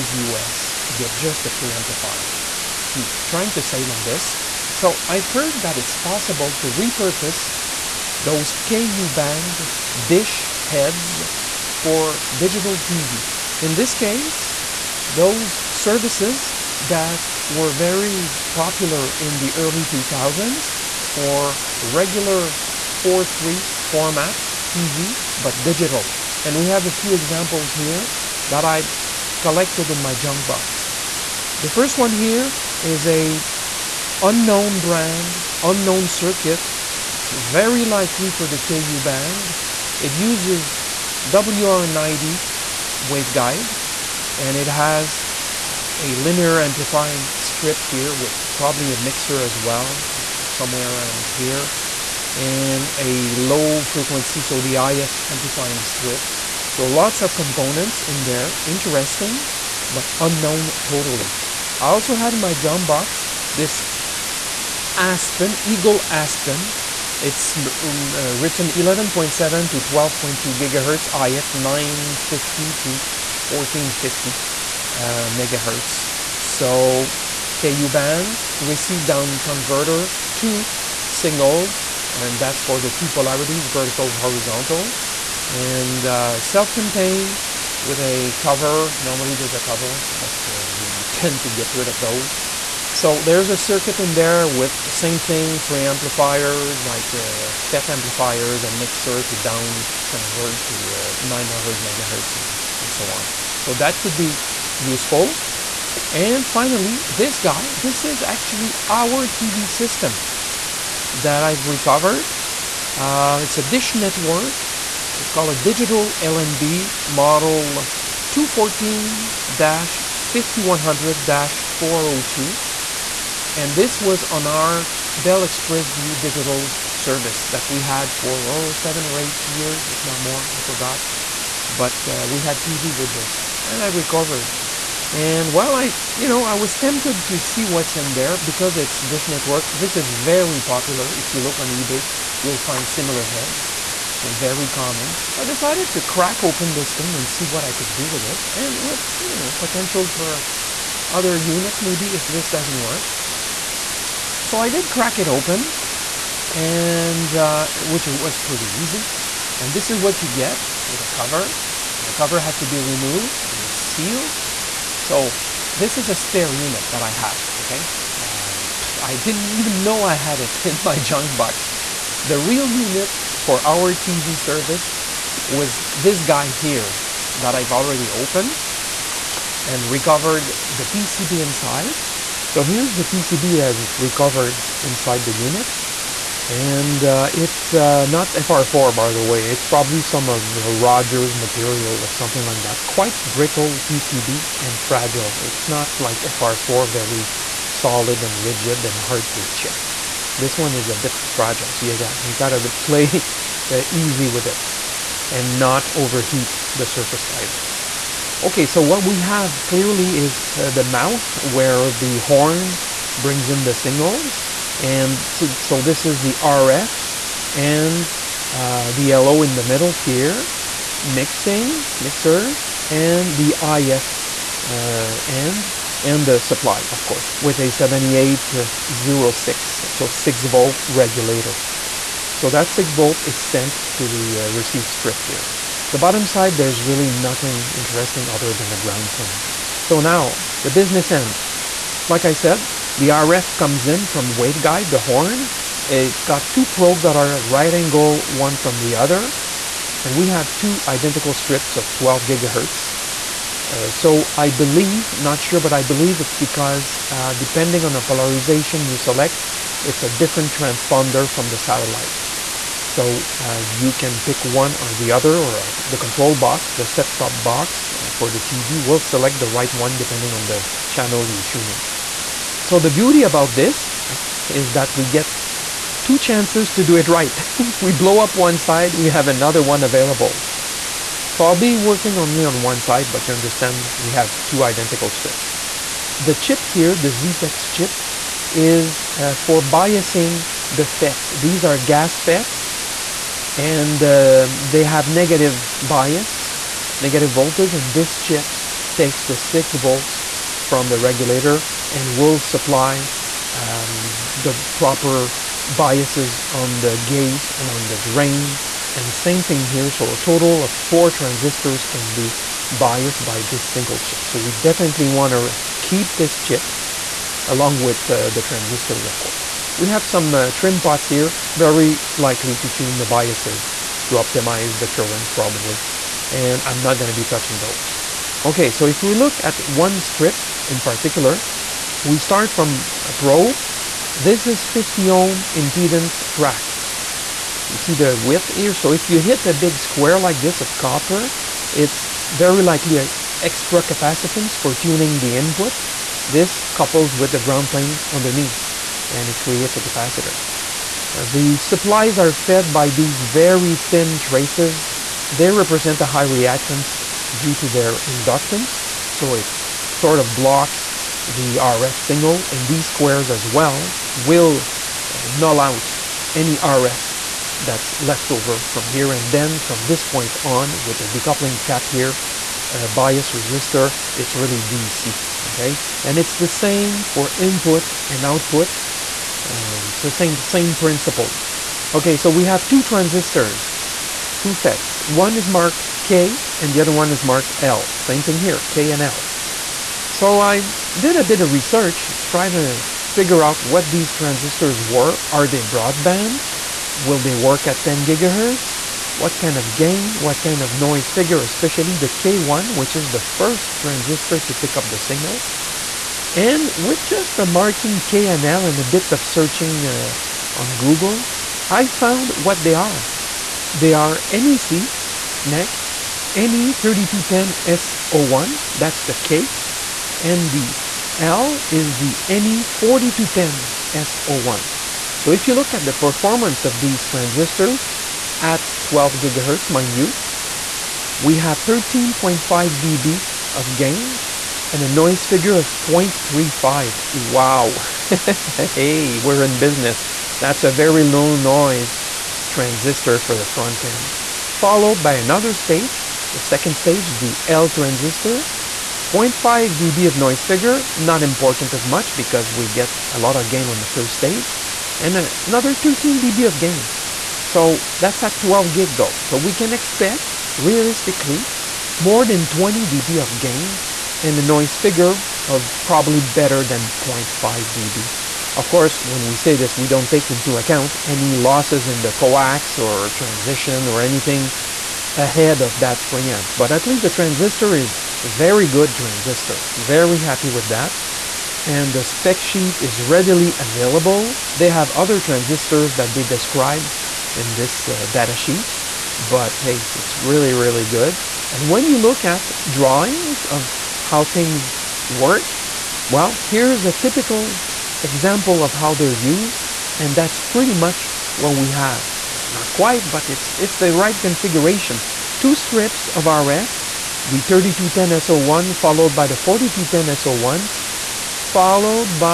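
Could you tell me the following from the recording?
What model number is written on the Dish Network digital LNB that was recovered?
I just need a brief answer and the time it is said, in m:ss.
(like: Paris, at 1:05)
214-5100-402, at 1:58.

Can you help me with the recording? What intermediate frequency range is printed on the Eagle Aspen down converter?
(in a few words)
950 to 1450 MHz.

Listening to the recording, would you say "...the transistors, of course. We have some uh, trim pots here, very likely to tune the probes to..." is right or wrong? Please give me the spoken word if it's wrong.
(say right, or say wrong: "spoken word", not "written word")
wrong: "biases", not "probes".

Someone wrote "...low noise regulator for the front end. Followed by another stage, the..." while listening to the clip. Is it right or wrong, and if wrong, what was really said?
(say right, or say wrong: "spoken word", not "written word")
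wrong: "transistor", not "regulator".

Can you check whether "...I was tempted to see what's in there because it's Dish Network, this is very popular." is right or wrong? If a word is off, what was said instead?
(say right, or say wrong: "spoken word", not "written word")
right.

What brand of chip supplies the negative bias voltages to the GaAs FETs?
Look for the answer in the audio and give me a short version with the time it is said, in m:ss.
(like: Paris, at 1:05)
ZTEX, at 4:47.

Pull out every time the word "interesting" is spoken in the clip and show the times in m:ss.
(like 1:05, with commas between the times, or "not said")
0:58, 3:57.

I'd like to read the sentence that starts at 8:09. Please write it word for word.
But hey, it's really, really good.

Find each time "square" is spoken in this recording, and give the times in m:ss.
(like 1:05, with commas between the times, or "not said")
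5:39, 6:02.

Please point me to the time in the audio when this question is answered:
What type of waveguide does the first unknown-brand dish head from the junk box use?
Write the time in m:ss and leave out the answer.
0:41.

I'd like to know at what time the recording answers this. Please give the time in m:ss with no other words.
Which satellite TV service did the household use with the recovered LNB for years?
2:05.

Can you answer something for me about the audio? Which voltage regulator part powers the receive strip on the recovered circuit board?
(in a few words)
7806.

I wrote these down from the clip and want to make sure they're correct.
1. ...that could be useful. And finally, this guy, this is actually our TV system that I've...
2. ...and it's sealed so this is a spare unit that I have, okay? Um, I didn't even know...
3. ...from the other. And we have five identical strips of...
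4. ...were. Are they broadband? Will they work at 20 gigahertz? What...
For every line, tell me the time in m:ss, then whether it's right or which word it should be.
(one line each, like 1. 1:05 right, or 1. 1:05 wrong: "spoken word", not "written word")
1. 1:43 right
2. 2:43 right
3. 4:08 wrong: "two", not "five"
4. 6:34 wrong: "10", not "20".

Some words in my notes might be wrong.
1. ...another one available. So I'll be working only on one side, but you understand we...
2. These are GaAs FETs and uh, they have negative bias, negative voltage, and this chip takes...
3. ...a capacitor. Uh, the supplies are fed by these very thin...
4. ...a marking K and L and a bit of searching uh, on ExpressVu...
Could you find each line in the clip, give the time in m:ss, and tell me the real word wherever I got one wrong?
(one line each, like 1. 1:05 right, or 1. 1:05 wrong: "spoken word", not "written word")
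1. 4:39 right
2. 4:51 right
3. 5:49 right
4. 6:47 wrong: "Google", not "ExpressVu".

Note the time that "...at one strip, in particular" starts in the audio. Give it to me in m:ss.
5:29.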